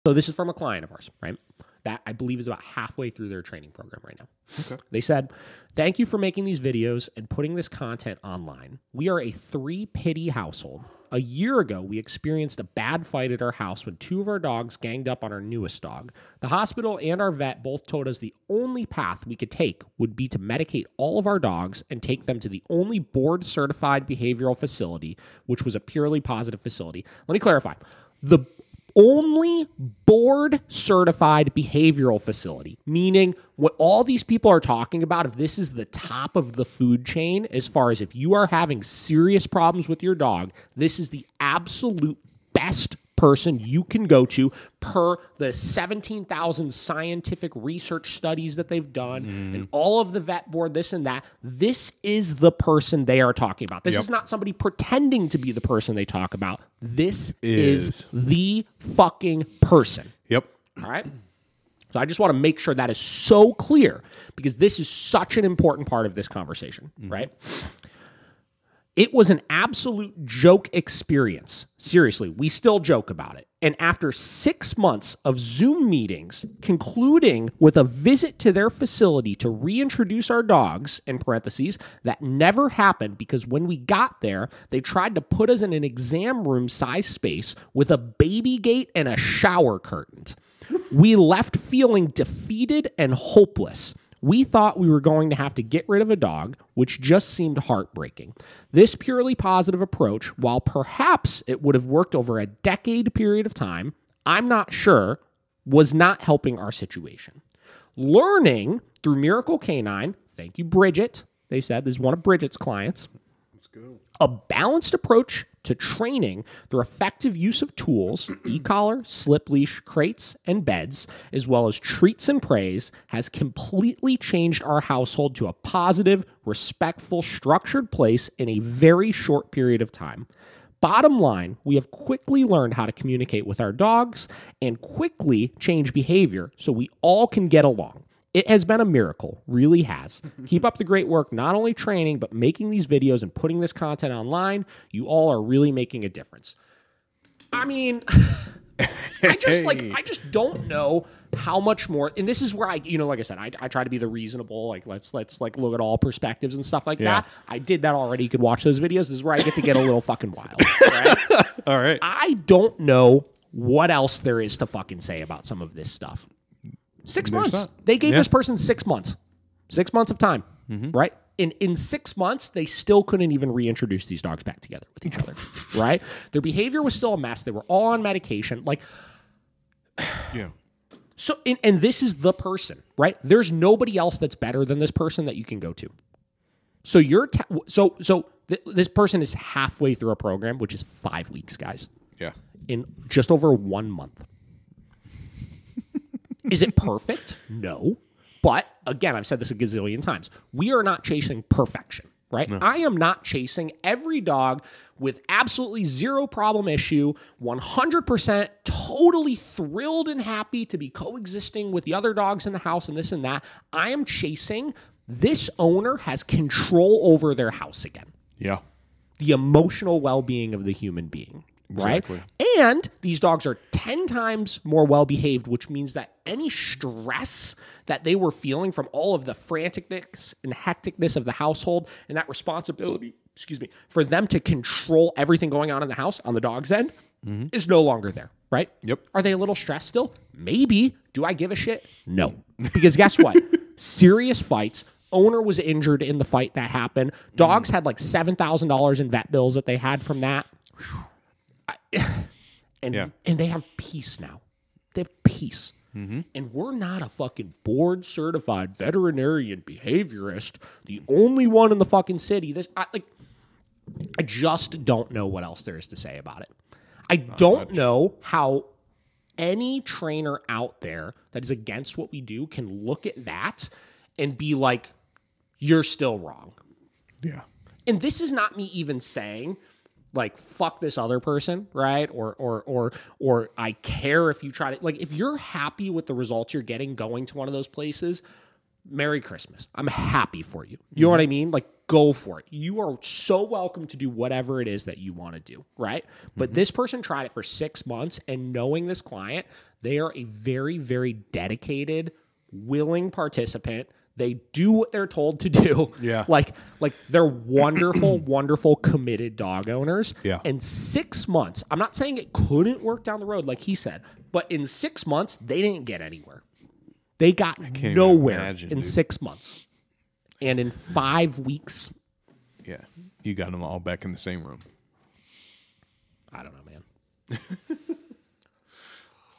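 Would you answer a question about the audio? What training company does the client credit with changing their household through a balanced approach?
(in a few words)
Miracle K9.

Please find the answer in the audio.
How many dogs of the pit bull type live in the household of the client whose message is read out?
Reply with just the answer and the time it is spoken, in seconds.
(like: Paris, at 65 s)
3, at 9 s.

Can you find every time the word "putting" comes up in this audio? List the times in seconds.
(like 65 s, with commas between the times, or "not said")
7 s, 143 s.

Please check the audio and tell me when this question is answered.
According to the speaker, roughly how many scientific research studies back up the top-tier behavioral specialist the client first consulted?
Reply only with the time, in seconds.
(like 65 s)
45 s.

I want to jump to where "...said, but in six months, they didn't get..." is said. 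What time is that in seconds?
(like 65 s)
313 s.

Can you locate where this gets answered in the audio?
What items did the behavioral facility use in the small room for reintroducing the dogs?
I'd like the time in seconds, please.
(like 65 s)
87 s.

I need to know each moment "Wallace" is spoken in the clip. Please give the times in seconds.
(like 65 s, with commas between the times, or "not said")
not said.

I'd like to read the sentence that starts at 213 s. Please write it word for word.
I am chasing this owner has control over their house again.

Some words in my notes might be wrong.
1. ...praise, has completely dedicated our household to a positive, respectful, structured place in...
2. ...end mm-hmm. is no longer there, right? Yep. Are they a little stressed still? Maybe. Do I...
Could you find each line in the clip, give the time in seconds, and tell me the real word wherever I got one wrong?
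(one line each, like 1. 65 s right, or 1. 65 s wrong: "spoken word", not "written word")
1. 122 s wrong: "changed", not "dedicated"
2. 236 s right.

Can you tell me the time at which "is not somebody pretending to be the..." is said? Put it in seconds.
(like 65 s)
54 s.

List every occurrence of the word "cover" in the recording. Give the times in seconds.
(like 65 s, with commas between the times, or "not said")
not said.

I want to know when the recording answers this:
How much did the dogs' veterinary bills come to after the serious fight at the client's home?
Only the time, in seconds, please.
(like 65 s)
247 s.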